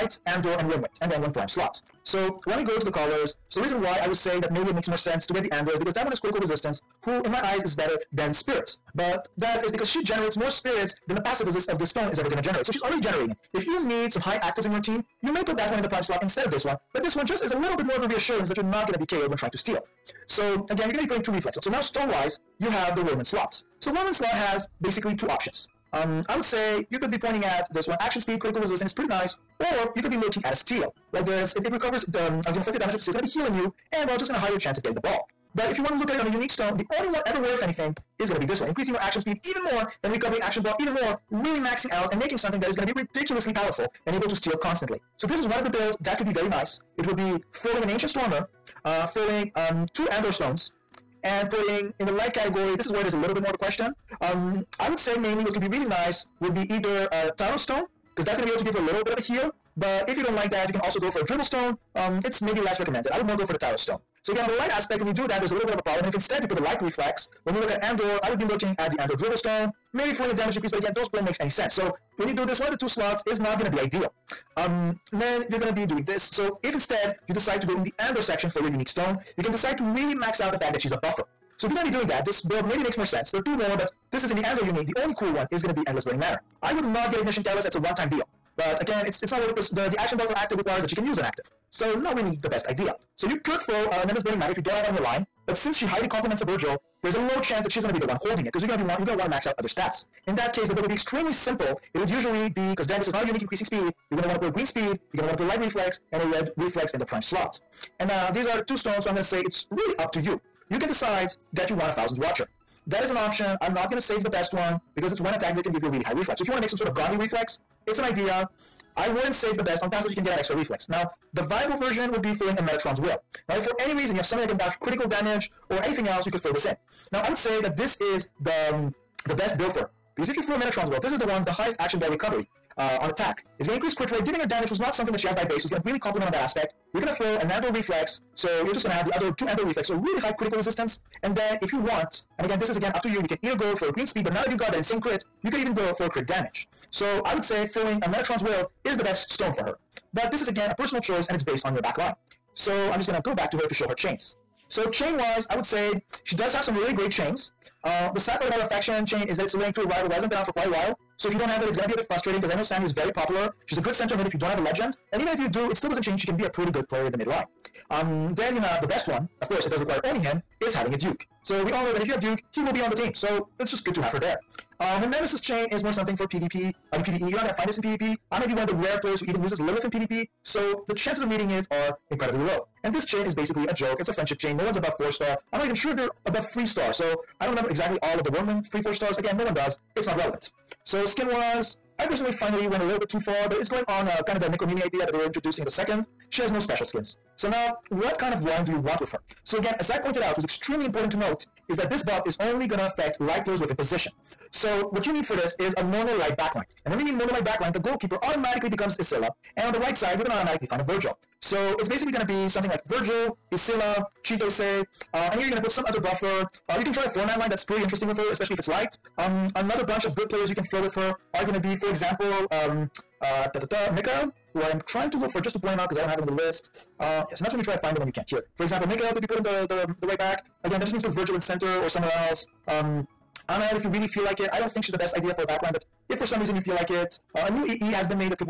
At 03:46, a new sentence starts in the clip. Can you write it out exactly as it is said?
Uh, yes, and that's when you try to find him and you can't.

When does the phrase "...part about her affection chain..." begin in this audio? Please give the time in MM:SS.
02:38.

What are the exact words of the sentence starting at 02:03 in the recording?
Now, if for any reason you have something that can buff critical damage or anything else, you could throw this in.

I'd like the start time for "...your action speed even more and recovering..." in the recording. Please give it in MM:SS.
00:38.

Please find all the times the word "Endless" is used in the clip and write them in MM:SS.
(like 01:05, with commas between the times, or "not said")
01:25, 01:34.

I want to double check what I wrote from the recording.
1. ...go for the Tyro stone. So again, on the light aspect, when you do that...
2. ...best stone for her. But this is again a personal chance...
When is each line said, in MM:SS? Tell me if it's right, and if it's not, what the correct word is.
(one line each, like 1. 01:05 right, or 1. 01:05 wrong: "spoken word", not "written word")
1. 01:03 right
2. 02:29 wrong: "choice", not "chance".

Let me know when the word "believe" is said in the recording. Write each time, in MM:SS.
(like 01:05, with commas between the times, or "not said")
not said.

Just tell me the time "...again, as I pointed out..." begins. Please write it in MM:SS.
03:19.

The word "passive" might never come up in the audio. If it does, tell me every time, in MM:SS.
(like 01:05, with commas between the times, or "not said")
00:11, 01:59.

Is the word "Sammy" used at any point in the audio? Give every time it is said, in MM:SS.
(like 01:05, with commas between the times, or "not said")
02:42.